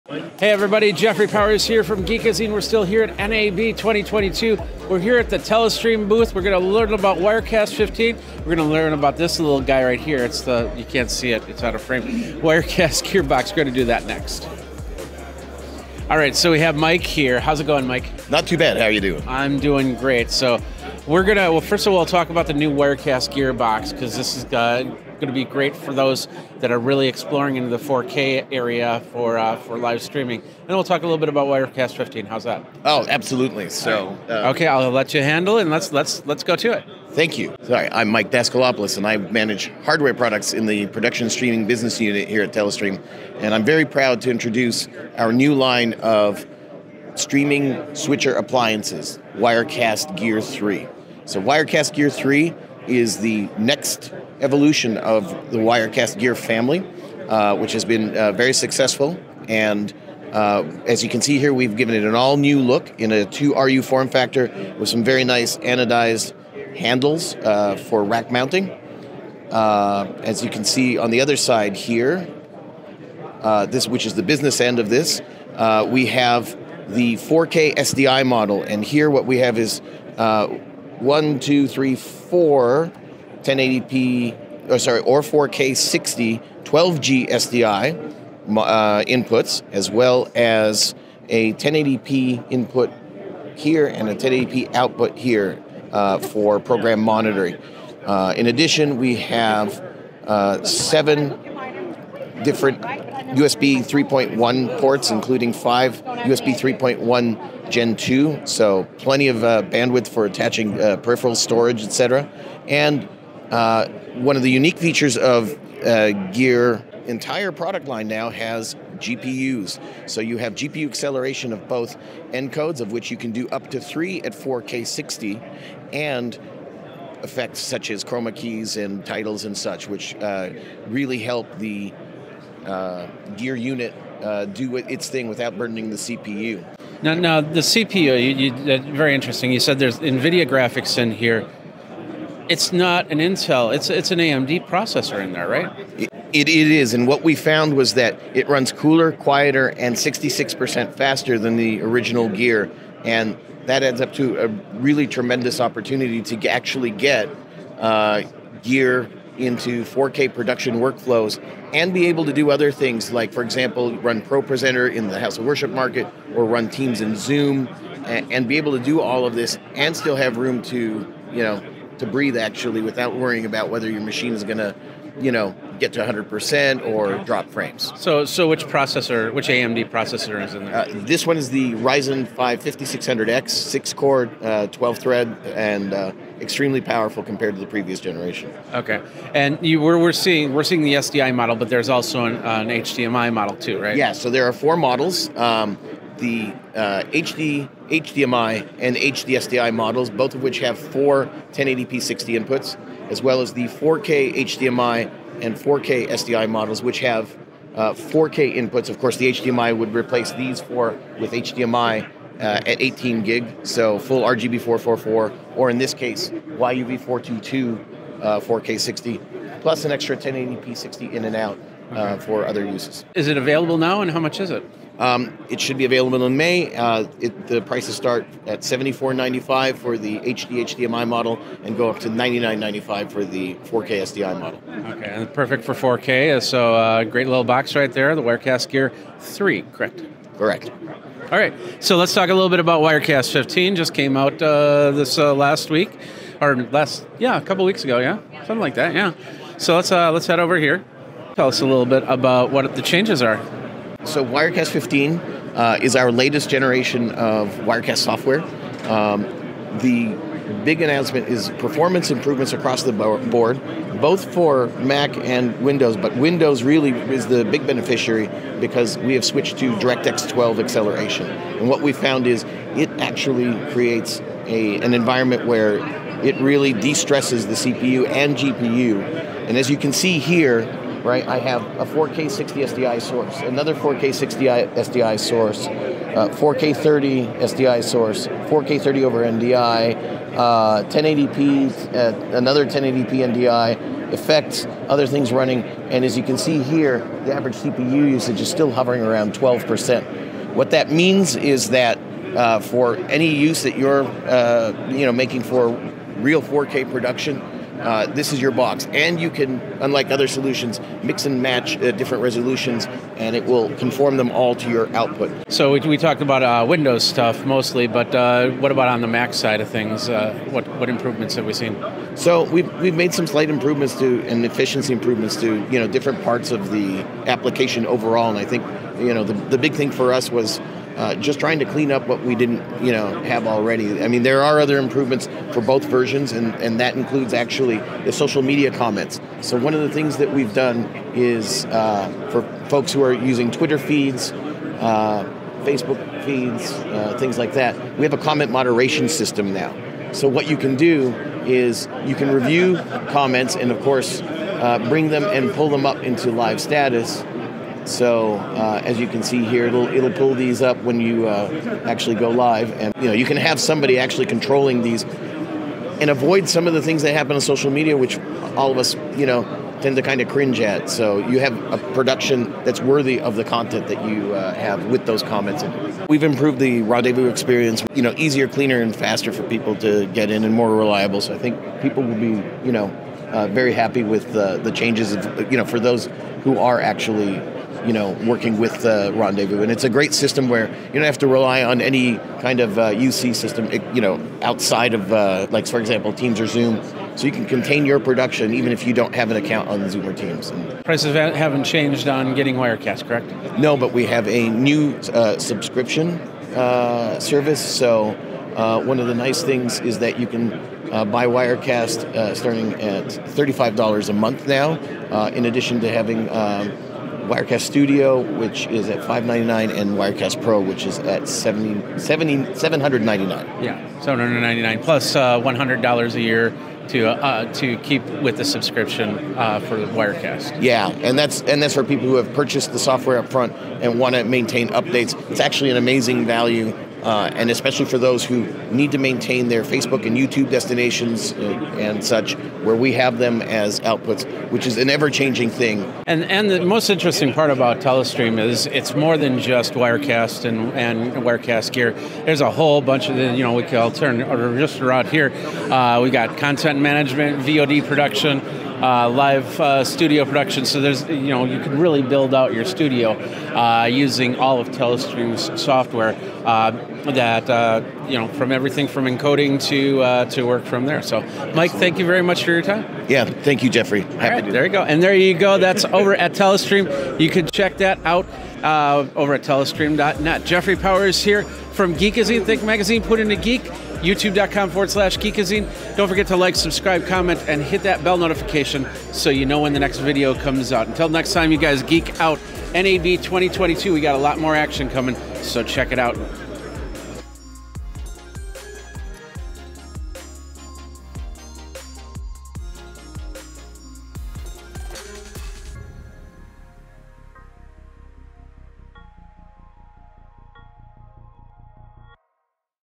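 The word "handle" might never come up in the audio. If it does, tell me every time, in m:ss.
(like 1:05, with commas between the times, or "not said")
0:35, 1:06.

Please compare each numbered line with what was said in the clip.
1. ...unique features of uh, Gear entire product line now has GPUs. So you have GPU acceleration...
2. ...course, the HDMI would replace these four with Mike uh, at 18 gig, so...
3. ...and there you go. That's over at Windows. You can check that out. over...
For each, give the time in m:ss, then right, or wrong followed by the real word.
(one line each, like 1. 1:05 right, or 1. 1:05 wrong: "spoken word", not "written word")
1. 1:54 right
2. 3:28 wrong: "HDMI", not "Mike"
3. 7:54 wrong: "Telestream", not "Windows".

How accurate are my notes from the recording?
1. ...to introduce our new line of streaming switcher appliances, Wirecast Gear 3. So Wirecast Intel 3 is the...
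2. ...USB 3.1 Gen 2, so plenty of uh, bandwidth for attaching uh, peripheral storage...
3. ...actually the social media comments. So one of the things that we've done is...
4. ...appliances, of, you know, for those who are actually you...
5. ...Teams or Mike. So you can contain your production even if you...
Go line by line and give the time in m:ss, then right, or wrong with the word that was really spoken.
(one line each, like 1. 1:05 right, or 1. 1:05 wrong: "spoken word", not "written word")
1. 0:44 wrong: "Gear", not "Intel"
2. 1:46 right
3. 5:37 right
4. 6:24 wrong: "changes", not "appliances"
5. 6:36 wrong: "Zoom", not "Mike".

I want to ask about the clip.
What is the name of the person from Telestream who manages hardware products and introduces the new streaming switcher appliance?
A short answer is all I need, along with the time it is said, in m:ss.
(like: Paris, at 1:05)
Mike Daskalopoulos, at 0:38.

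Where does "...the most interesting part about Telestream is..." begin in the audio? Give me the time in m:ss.
7:26.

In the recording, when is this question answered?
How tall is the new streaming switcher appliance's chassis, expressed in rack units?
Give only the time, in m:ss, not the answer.
1:03.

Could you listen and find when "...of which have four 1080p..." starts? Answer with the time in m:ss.
3:20.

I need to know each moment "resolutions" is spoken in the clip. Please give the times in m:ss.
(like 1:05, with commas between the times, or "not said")
5:12.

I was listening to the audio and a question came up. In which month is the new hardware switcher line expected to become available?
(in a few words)
May.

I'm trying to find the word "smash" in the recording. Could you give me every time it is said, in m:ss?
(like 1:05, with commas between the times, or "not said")
not said.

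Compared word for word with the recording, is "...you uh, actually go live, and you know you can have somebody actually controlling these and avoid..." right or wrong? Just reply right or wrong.
right.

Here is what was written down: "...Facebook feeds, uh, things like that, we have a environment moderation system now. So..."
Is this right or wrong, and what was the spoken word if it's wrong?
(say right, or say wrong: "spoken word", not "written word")
wrong: "comment", not "environment".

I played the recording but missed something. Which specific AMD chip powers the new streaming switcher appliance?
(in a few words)
Ryzen 5 5600X.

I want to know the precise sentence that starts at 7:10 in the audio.
Yeah, and that's and that's for people who have purchased the software up front and want to maintain updates.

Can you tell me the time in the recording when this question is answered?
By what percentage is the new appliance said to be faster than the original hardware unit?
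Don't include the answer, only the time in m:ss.
2:29.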